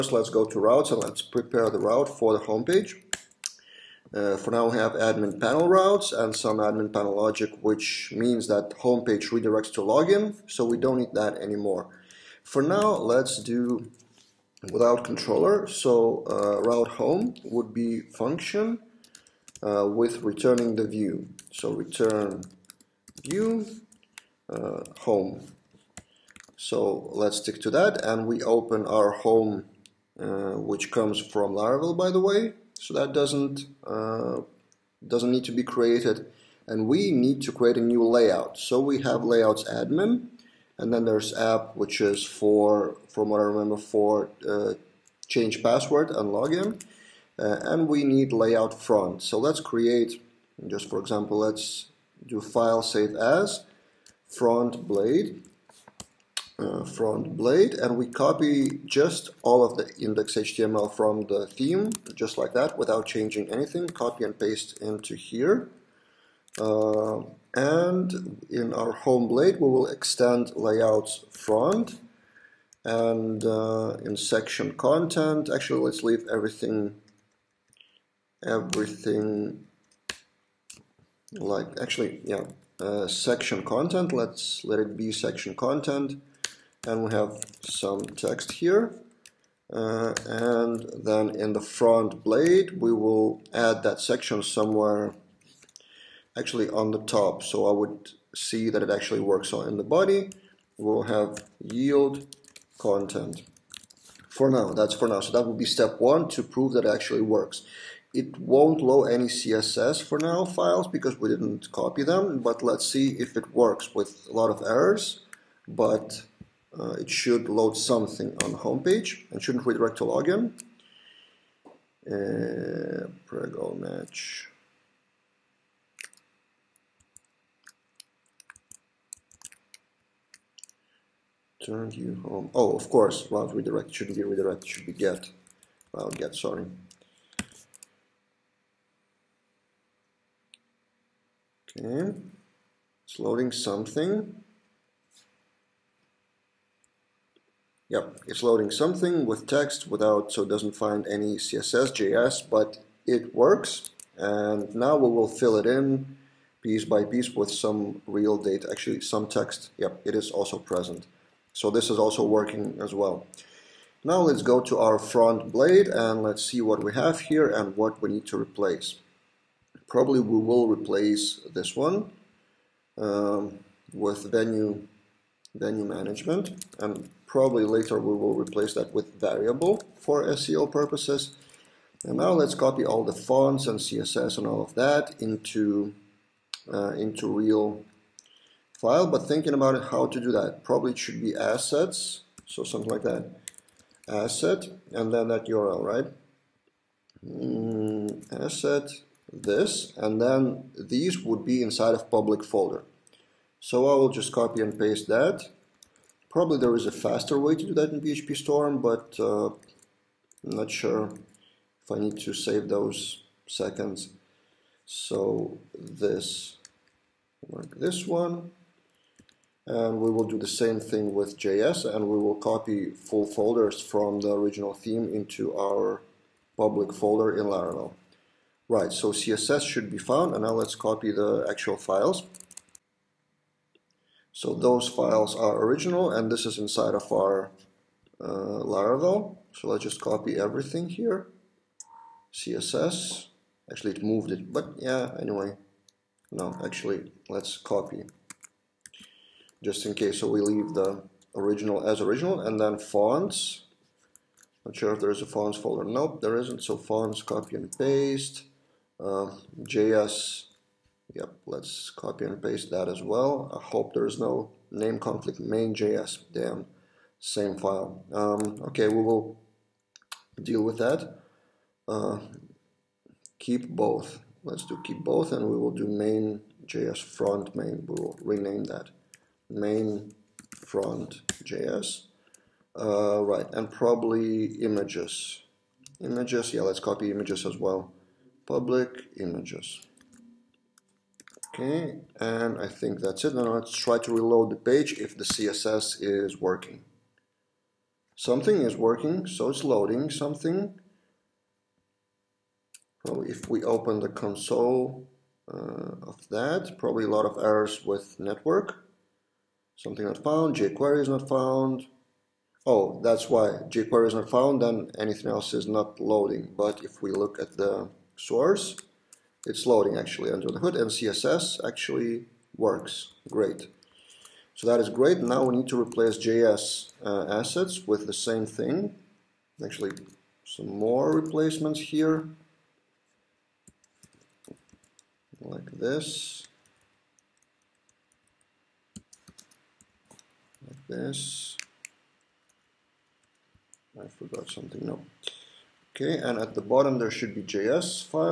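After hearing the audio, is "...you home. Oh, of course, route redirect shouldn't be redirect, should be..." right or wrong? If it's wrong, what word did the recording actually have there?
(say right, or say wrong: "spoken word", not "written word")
right.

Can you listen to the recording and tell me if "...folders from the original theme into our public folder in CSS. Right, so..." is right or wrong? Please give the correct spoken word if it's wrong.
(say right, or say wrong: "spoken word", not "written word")
wrong: "Laravel", not "CSS".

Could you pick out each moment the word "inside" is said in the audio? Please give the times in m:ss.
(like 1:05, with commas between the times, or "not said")
3:21, 3:56.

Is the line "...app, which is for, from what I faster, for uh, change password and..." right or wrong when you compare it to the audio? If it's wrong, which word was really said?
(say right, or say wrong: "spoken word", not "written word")
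wrong: "remember", not "faster".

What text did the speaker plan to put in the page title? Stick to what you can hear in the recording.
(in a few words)
venue management.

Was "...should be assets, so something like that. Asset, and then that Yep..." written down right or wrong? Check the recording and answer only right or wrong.
wrong.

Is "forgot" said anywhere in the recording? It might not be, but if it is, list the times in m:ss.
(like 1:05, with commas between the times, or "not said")
5:44.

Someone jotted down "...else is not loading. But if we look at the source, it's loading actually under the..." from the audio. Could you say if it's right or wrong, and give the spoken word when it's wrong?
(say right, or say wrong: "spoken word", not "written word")
right.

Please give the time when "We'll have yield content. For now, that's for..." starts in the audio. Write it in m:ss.
1:40.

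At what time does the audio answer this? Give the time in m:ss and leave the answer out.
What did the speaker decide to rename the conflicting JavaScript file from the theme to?
4:39.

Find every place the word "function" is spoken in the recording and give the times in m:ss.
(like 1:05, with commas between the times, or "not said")
0:17.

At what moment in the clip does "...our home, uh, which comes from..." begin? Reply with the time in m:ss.
0:28.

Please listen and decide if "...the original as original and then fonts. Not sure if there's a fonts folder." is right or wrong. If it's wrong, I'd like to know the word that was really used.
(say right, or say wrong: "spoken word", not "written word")
right.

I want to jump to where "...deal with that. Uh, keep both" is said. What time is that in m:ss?
4:30.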